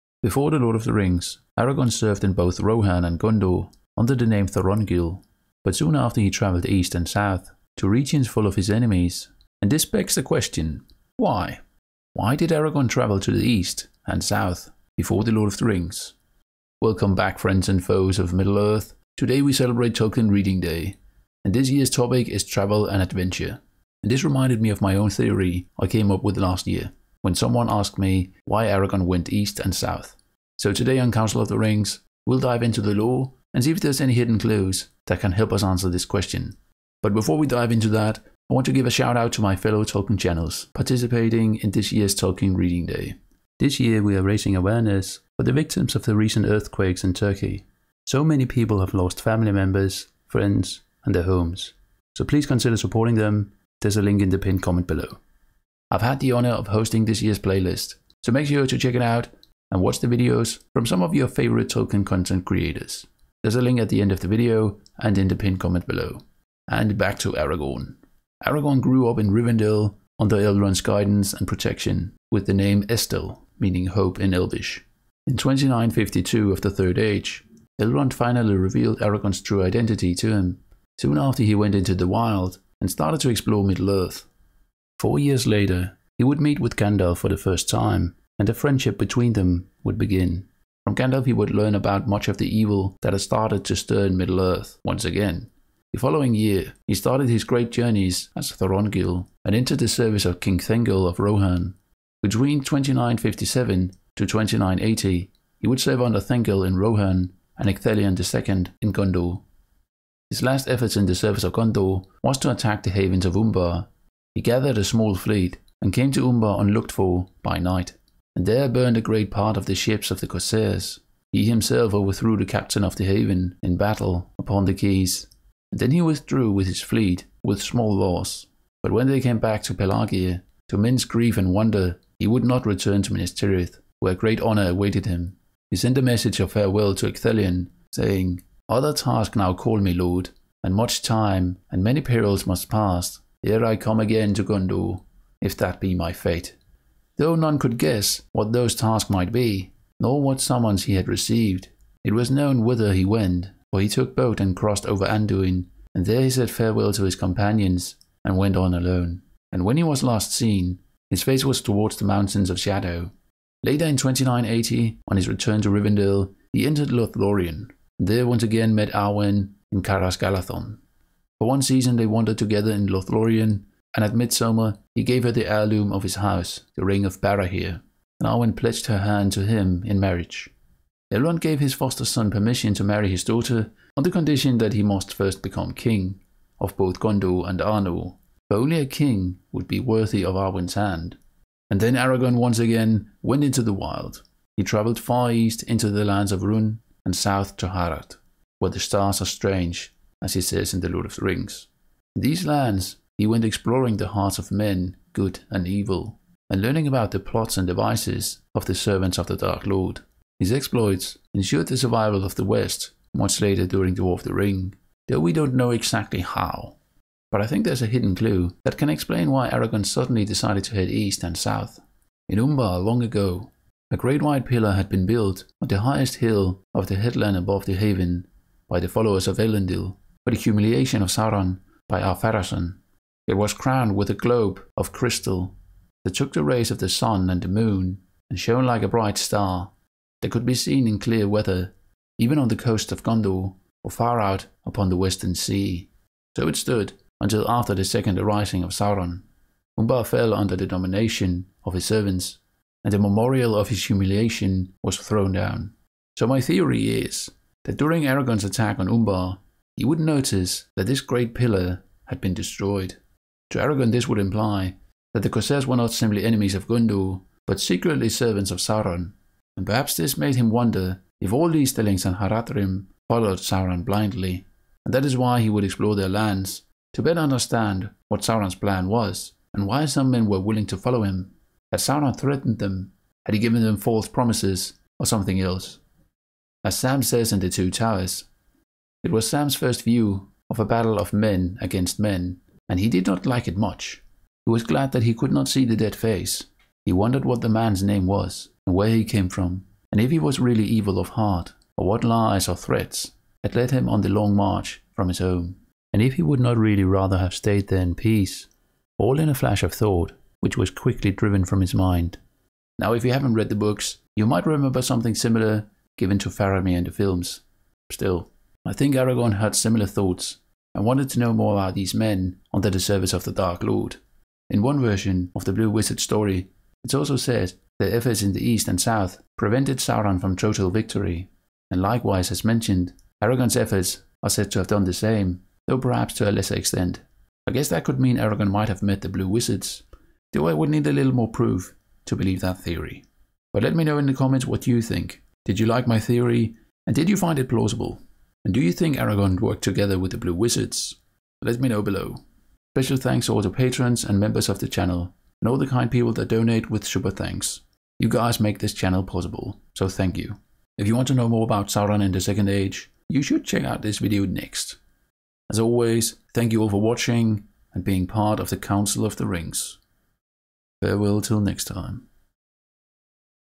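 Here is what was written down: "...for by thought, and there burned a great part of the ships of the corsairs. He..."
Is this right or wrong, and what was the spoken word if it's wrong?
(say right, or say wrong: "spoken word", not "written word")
wrong: "night", not "thought".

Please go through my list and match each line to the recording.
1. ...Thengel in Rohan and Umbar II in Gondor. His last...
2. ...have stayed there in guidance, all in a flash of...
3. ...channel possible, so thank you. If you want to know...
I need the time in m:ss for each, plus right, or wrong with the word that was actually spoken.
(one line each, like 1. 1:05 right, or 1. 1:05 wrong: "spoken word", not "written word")
1. 1:46 wrong: "Ecthelion", not "Umbar"
2. 5:07 wrong: "peace", not "guidance"
3. 5:58 right.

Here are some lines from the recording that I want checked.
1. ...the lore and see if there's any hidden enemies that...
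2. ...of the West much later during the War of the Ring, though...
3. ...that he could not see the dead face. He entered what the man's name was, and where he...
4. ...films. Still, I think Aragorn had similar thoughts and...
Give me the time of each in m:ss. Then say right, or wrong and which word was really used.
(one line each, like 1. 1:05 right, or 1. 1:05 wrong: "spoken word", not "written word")
1. 0:32 wrong: "clues", not "enemies"
2. 3:32 right
3. 4:54 wrong: "wondered", not "entered"
4. 5:16 right.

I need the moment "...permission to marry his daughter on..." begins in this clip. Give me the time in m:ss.
3:02.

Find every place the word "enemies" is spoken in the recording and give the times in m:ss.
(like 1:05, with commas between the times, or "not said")
0:08, 4:26.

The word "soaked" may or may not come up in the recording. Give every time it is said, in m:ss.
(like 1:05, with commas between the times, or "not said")
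not said.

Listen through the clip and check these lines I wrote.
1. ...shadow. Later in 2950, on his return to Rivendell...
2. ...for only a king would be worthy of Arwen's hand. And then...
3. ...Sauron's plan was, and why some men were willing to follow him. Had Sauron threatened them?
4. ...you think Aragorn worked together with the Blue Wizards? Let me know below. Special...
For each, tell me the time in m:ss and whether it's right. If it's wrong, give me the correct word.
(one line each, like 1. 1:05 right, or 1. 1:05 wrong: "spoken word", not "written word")
1. 2:42 wrong: "2980", not "2950"
2. 3:08 right
3. 4:38 right
4. 5:48 right.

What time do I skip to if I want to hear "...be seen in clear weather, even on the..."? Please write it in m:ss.
4:00.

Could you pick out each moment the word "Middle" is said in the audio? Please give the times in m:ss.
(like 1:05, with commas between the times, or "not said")
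0:18, 1:23, 1:34.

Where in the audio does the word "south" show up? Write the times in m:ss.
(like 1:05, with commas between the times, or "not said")
0:07, 0:14, 0:29, 3:17, 3:41, 5:28.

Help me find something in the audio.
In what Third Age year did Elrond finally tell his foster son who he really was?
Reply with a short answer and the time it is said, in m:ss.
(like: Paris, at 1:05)
2952, at 1:15.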